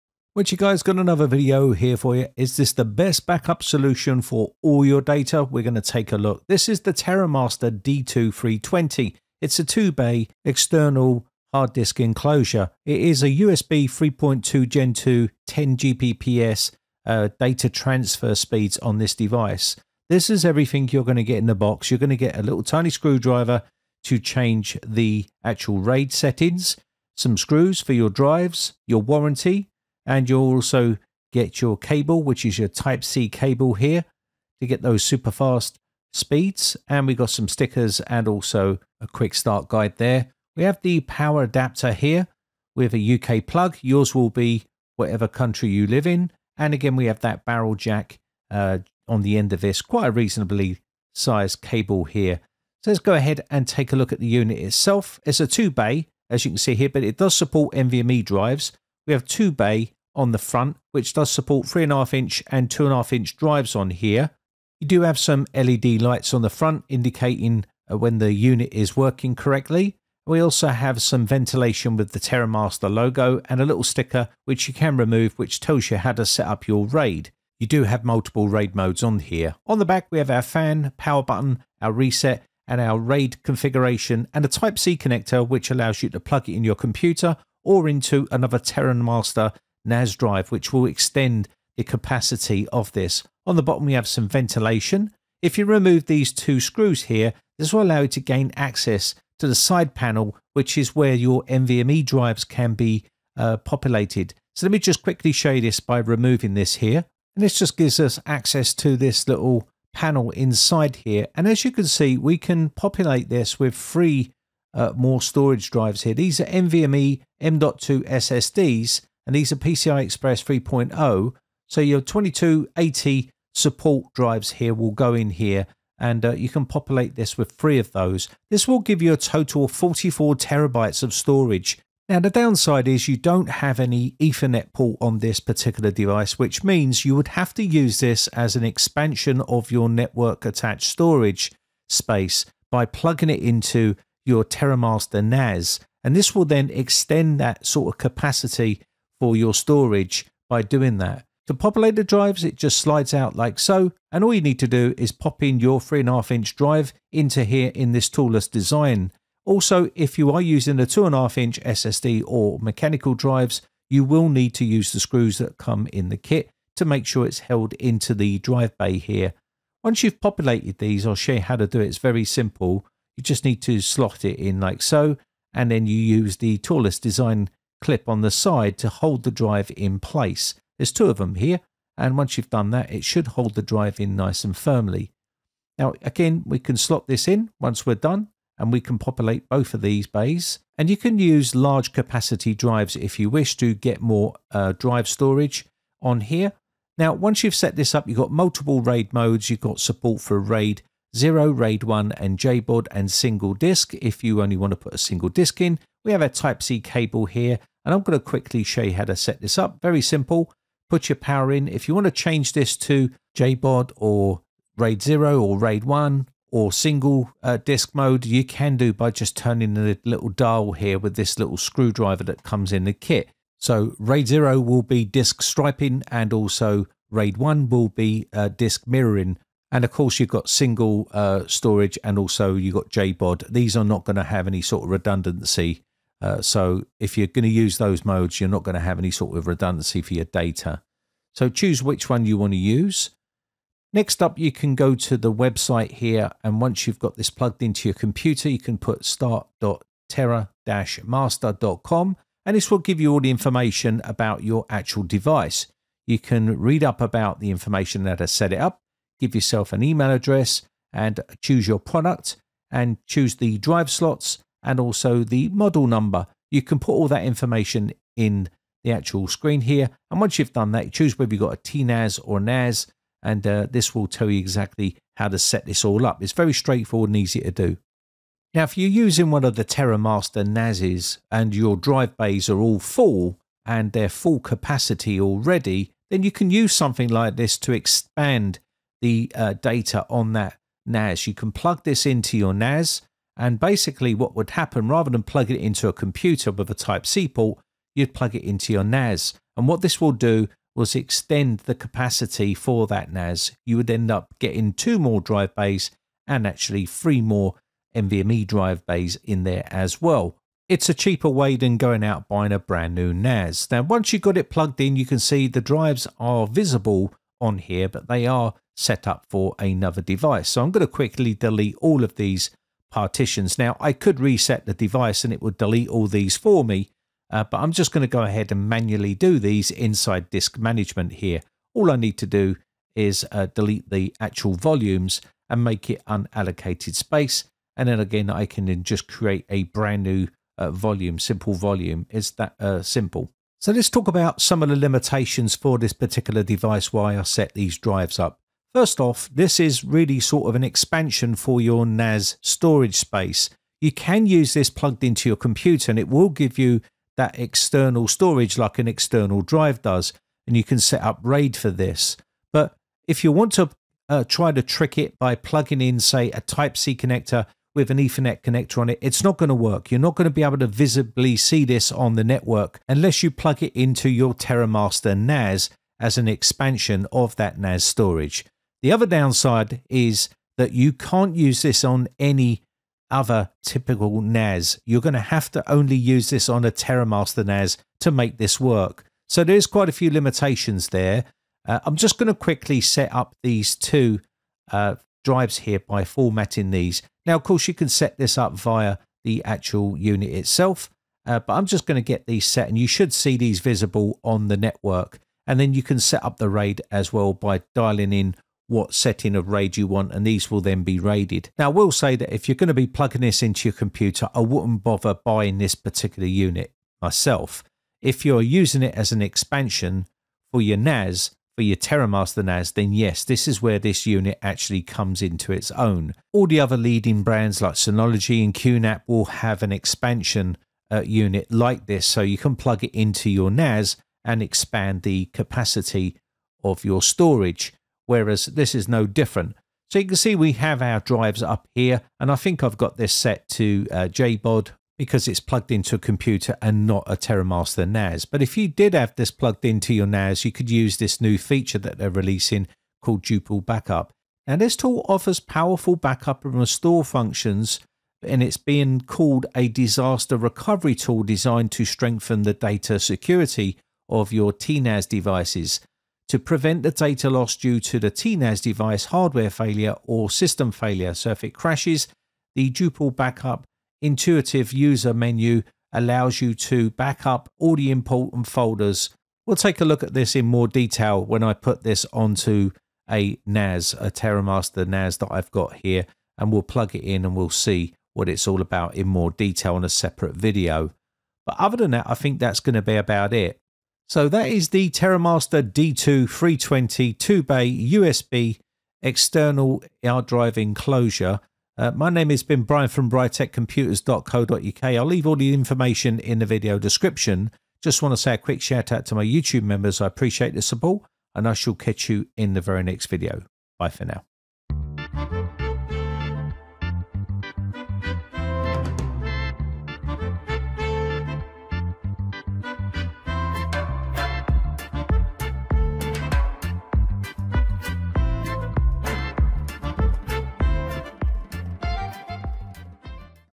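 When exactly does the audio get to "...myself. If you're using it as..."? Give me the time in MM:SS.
06:57.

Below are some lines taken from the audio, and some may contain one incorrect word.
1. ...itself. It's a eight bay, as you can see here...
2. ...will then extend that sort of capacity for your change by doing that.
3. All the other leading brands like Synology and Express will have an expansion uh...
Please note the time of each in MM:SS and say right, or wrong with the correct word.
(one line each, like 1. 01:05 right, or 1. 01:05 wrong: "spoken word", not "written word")
1. 00:54 wrong: "two", not "eight"
2. 02:26 wrong: "storage", not "change"
3. 07:06 wrong: "QNAP", not "Express".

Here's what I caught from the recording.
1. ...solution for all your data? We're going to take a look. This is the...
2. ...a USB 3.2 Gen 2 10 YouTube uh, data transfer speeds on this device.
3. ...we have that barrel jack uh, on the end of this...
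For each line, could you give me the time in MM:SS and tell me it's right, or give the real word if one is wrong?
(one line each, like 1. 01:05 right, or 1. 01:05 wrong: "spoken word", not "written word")
1. 00:03 right
2. 00:13 wrong: "Gbps", not "YouTube"
3. 00:46 right.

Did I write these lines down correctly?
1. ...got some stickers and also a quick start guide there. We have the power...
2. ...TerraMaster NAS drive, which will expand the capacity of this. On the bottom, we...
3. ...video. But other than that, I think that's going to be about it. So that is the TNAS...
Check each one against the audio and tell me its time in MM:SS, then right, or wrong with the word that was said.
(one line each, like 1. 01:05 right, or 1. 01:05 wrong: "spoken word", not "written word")
1. 00:37 right
2. 01:28 wrong: "extend", not "expand"
3. 08:10 wrong: "TerraMaster", not "TNAS".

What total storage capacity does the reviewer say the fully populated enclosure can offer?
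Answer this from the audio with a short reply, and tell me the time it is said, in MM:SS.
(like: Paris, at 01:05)
44 terabytes, at 02:09.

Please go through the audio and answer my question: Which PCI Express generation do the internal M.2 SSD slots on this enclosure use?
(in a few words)
PCI Express 3.0.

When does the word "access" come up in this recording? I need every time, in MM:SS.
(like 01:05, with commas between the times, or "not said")
01:38, 01:48.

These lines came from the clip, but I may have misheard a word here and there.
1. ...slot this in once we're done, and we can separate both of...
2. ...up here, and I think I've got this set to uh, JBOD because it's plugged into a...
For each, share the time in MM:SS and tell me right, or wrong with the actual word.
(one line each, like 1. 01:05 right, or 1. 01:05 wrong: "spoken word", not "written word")
1. 03:06 wrong: "populate", not "separate"
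2. 07:21 right.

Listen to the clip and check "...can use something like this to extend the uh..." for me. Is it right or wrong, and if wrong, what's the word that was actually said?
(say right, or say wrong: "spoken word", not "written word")
wrong: "expand", not "extend".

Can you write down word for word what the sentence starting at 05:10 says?
It's a cheaper way than going out buying a brand new NAS.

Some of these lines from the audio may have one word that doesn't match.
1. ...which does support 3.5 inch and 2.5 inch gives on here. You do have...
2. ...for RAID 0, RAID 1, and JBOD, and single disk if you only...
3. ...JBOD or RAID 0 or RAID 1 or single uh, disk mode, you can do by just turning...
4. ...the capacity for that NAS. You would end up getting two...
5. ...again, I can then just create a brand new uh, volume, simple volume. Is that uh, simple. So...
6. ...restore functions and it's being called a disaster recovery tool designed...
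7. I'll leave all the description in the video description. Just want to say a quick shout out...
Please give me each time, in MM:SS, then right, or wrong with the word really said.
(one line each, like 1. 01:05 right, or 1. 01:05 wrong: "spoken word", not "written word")
1. 01:00 wrong: "drives", not "gives"
2. 03:20 right
3. 03:33 right
4. 05:01 right
5. 05:38 right
6. 07:36 right
7. 08:24 wrong: "information", not "description".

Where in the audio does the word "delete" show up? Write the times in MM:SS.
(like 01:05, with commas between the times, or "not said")
05:21, 05:25, 05:33.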